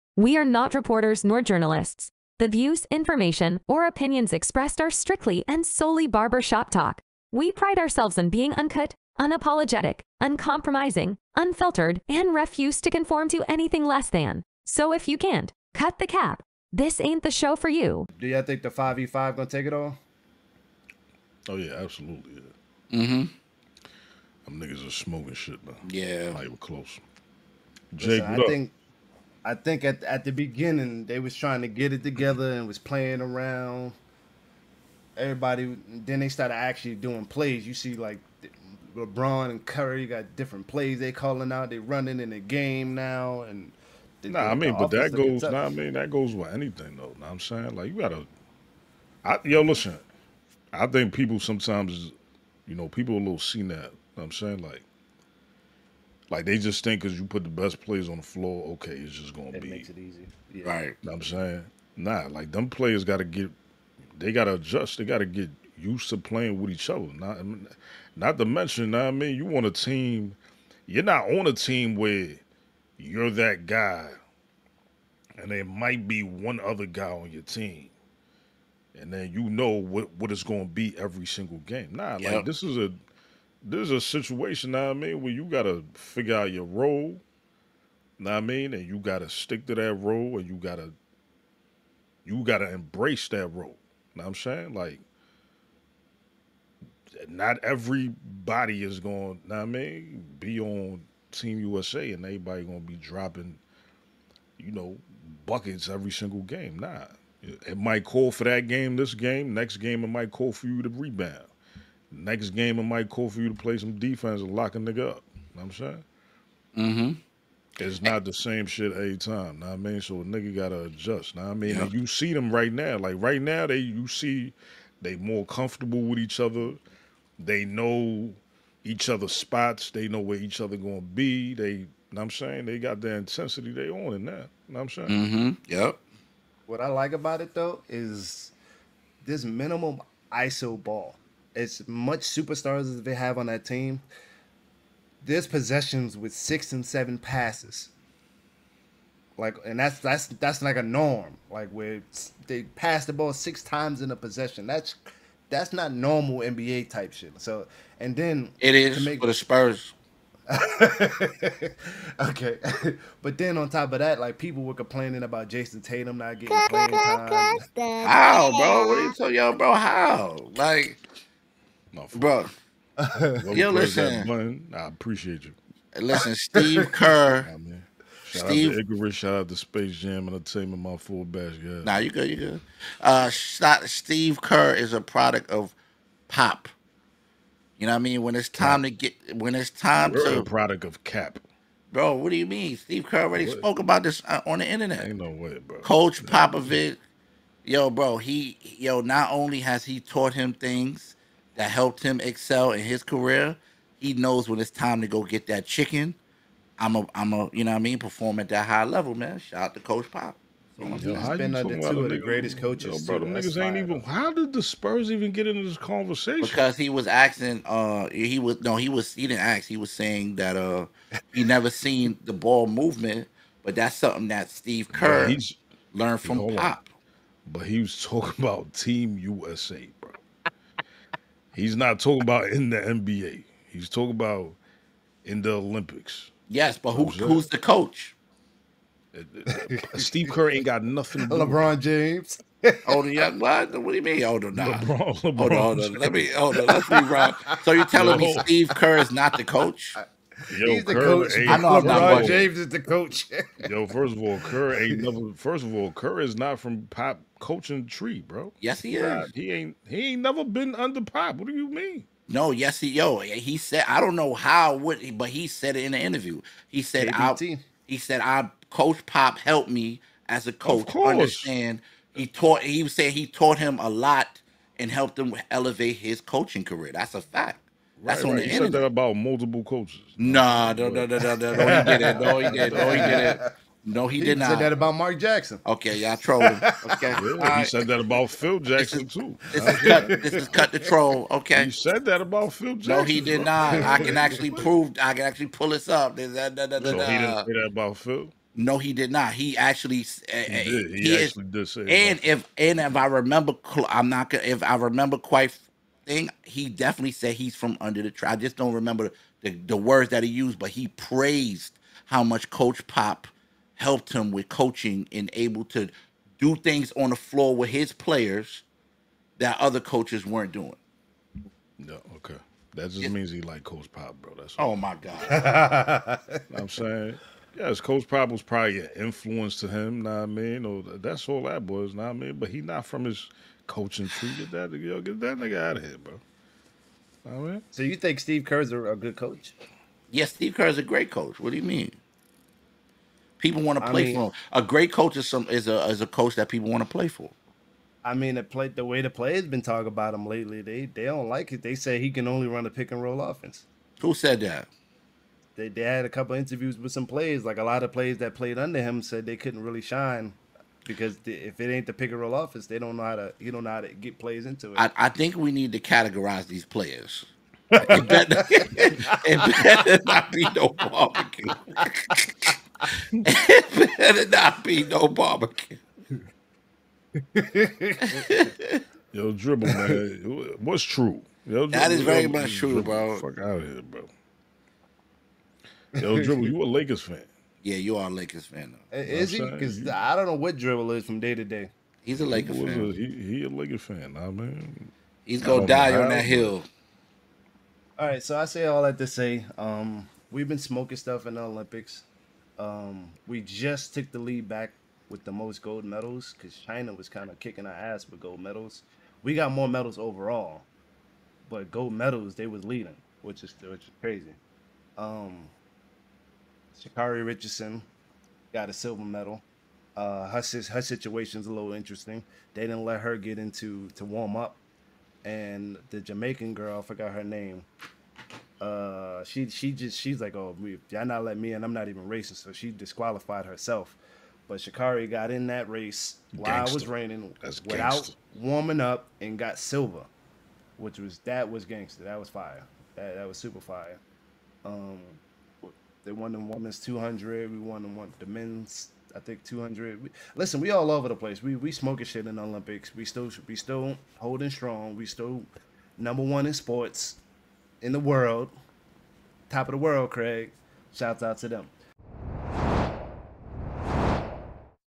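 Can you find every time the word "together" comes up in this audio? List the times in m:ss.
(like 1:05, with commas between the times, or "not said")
0:32.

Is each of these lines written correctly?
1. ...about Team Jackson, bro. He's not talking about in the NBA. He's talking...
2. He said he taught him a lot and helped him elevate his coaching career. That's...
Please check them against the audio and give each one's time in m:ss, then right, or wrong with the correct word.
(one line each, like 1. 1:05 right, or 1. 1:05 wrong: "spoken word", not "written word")
1. 3:48 wrong: "USA", not "Jackson"
2. 4:32 right.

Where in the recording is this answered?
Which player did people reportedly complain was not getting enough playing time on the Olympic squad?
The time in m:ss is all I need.
2:45.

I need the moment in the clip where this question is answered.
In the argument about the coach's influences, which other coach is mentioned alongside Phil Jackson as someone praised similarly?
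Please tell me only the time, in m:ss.
4:44.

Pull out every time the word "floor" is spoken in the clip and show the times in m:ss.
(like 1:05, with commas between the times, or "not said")
0:58, 5:17.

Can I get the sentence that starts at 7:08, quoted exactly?
Uh, she she just she's like, oh, y'all not let me in.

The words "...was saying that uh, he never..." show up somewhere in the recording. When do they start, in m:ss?
3:39.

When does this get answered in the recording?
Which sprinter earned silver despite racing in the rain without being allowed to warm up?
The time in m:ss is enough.
6:56.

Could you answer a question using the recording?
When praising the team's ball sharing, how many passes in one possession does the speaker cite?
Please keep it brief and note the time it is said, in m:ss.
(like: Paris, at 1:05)
six and seven, at 2:26.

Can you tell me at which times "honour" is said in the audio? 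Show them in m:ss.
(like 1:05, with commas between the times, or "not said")
not said.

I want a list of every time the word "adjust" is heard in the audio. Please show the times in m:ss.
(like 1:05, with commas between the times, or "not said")
1:04, 2:00.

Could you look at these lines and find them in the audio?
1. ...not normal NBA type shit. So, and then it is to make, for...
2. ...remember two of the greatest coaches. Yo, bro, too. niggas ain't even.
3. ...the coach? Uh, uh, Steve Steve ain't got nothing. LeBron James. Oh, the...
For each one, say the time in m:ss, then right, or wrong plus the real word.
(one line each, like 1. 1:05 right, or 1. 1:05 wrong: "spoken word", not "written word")
1. 2:35 right
2. 3:31 wrong: "under", not "remember"
3. 3:57 wrong: "Kerr", not "Steve".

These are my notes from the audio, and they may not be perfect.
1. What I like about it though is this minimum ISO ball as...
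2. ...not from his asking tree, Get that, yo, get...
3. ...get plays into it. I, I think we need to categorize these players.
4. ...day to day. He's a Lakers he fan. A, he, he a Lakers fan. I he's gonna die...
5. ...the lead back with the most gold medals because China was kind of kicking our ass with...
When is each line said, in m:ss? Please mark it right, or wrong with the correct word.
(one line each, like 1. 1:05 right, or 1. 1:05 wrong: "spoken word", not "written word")
1. 2:16 right
2. 5:32 wrong: "coaching", not "asking"
3. 6:03 right
4. 6:31 right
5. 6:44 right.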